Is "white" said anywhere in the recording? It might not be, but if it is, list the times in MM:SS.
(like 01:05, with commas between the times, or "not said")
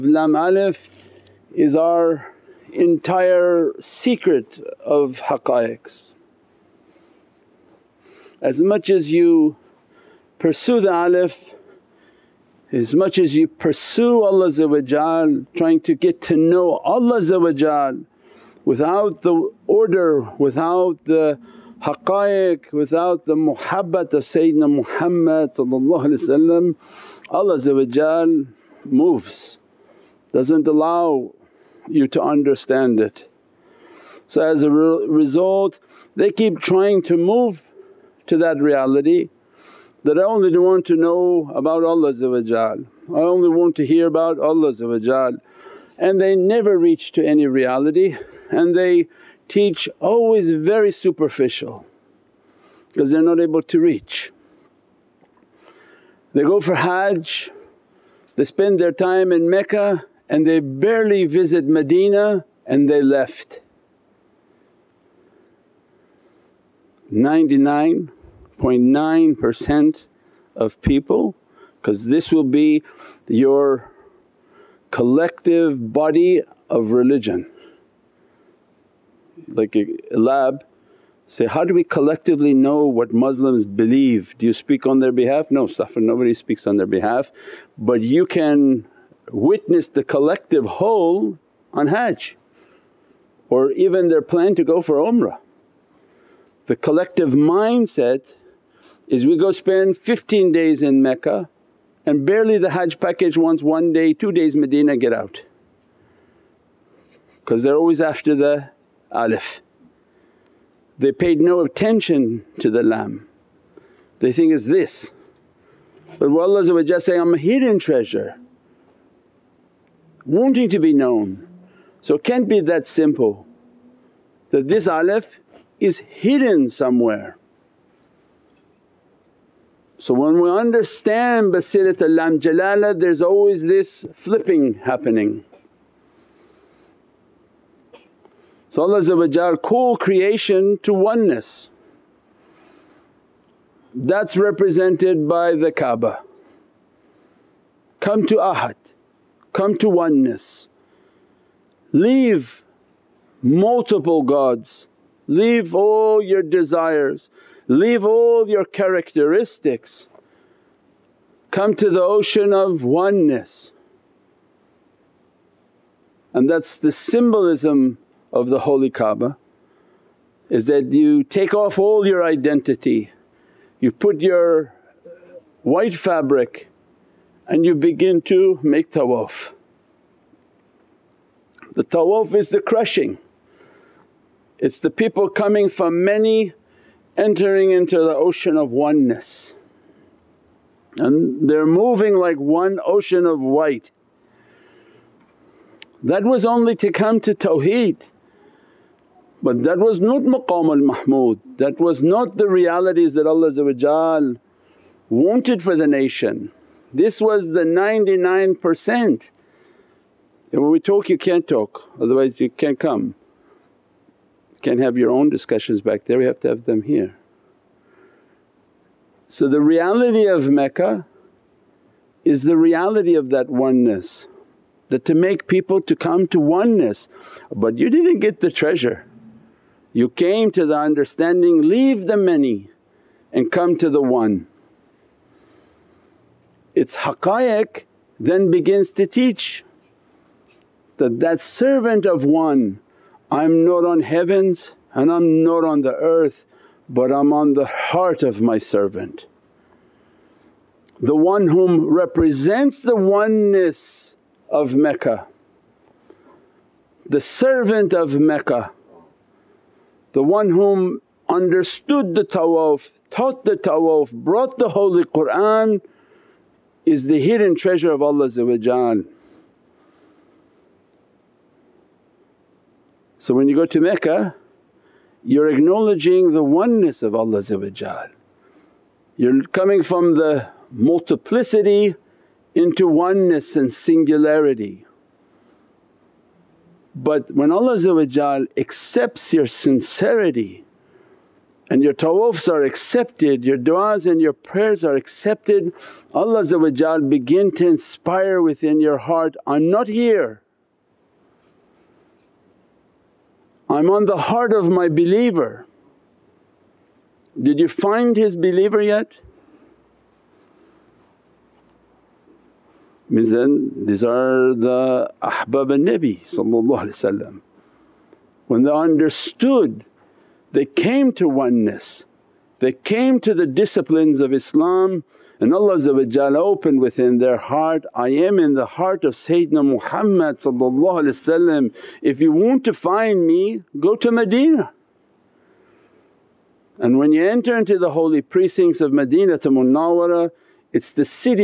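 02:55, 03:13.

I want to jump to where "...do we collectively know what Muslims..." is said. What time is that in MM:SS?
01:21.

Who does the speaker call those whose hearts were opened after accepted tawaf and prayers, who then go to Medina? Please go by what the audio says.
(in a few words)
ahbab al Nabi.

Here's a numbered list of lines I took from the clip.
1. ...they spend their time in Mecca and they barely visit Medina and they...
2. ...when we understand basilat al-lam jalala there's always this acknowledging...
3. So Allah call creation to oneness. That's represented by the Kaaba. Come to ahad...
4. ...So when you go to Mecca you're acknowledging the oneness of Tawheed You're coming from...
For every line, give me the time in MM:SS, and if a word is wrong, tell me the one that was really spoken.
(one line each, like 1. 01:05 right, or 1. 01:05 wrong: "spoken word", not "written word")
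1. 00:58 right
2. 02:10 wrong: "flipping", not "acknowledging"
3. 02:18 right
4. 04:28 wrong: "Allah", not "Tawheed".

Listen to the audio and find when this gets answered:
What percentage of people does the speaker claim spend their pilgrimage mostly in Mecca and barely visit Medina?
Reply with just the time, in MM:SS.
01:07.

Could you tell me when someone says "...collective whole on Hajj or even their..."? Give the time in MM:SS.
01:30.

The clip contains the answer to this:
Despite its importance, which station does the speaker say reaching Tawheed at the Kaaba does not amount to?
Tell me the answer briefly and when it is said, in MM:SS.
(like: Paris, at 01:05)
maqam al-mahmud, at 03:20.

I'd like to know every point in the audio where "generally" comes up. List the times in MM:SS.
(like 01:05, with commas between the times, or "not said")
not said.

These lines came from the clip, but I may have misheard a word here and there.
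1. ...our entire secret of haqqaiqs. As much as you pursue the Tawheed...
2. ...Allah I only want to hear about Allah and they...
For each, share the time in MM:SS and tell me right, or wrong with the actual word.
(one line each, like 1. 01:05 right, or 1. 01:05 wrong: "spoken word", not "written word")
1. 00:01 wrong: "Alif", not "Tawheed"
2. 00:41 right.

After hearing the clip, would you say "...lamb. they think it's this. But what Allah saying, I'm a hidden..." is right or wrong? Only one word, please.
right.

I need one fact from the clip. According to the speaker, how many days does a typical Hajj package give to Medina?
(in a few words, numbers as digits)
one day, two days.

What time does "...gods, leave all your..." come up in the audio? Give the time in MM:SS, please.
02:34.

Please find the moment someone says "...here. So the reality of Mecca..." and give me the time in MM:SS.
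03:36.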